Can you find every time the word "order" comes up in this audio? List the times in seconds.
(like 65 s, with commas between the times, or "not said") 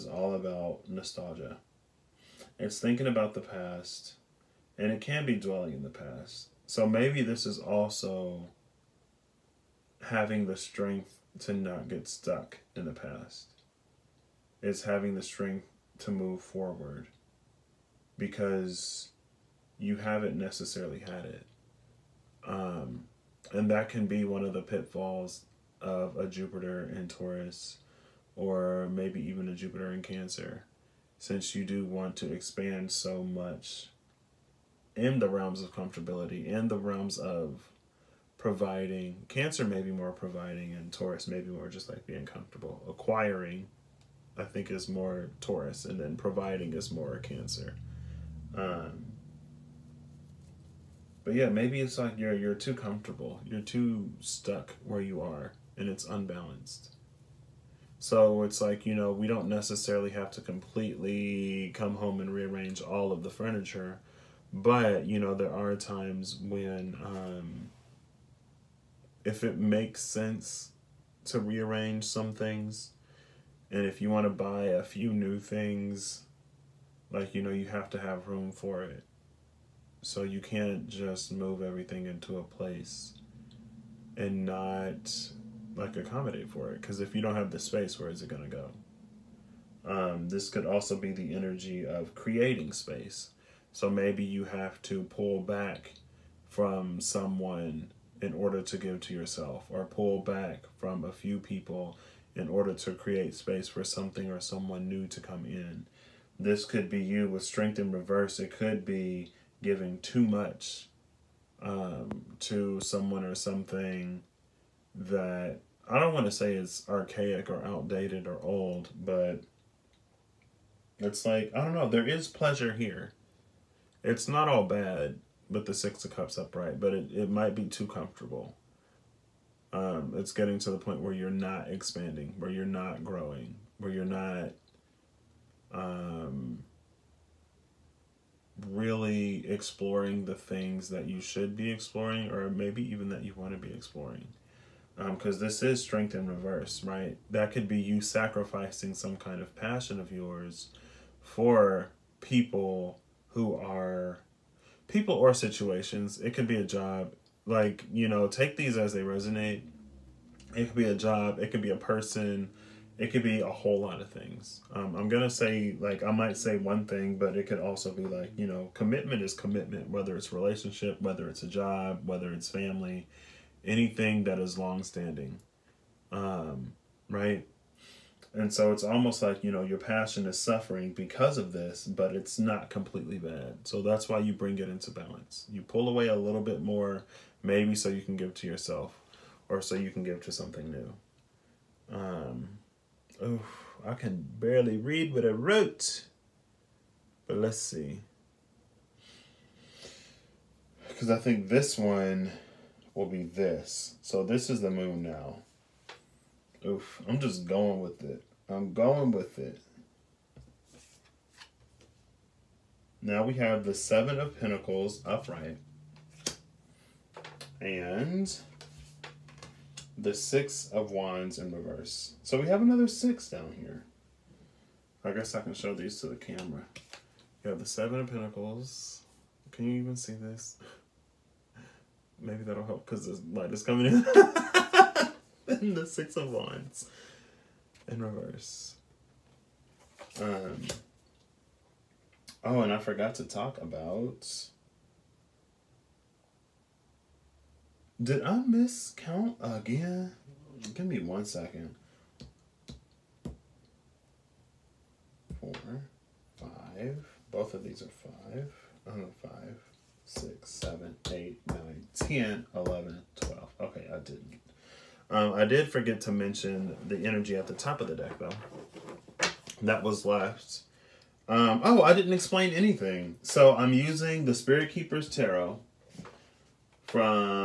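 98 s, 102 s.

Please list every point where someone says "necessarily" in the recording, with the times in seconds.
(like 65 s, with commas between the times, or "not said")
20 s, 59 s.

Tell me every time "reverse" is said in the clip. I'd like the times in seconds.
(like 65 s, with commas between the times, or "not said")
107 s, 146 s, 221 s, 238 s.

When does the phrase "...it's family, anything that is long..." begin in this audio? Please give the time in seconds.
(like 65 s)
172 s.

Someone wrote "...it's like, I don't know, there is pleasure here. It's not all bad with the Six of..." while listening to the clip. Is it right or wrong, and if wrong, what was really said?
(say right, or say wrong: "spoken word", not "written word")
right.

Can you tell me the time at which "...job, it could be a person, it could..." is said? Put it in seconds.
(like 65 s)
160 s.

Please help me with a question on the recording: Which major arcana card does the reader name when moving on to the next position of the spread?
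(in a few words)
The Moon.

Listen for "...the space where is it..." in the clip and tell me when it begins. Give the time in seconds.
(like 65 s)
87 s.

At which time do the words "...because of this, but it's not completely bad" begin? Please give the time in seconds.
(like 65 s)
180 s.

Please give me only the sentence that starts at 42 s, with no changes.
Acquiring, I think, is more Taurus, and then providing is more Cancer.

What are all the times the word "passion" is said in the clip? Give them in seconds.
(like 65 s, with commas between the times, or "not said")
149 s, 179 s.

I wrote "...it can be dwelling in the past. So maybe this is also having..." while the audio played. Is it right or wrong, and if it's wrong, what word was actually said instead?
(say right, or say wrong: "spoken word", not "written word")
right.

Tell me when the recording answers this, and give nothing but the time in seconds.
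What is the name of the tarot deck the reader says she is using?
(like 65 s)
274 s.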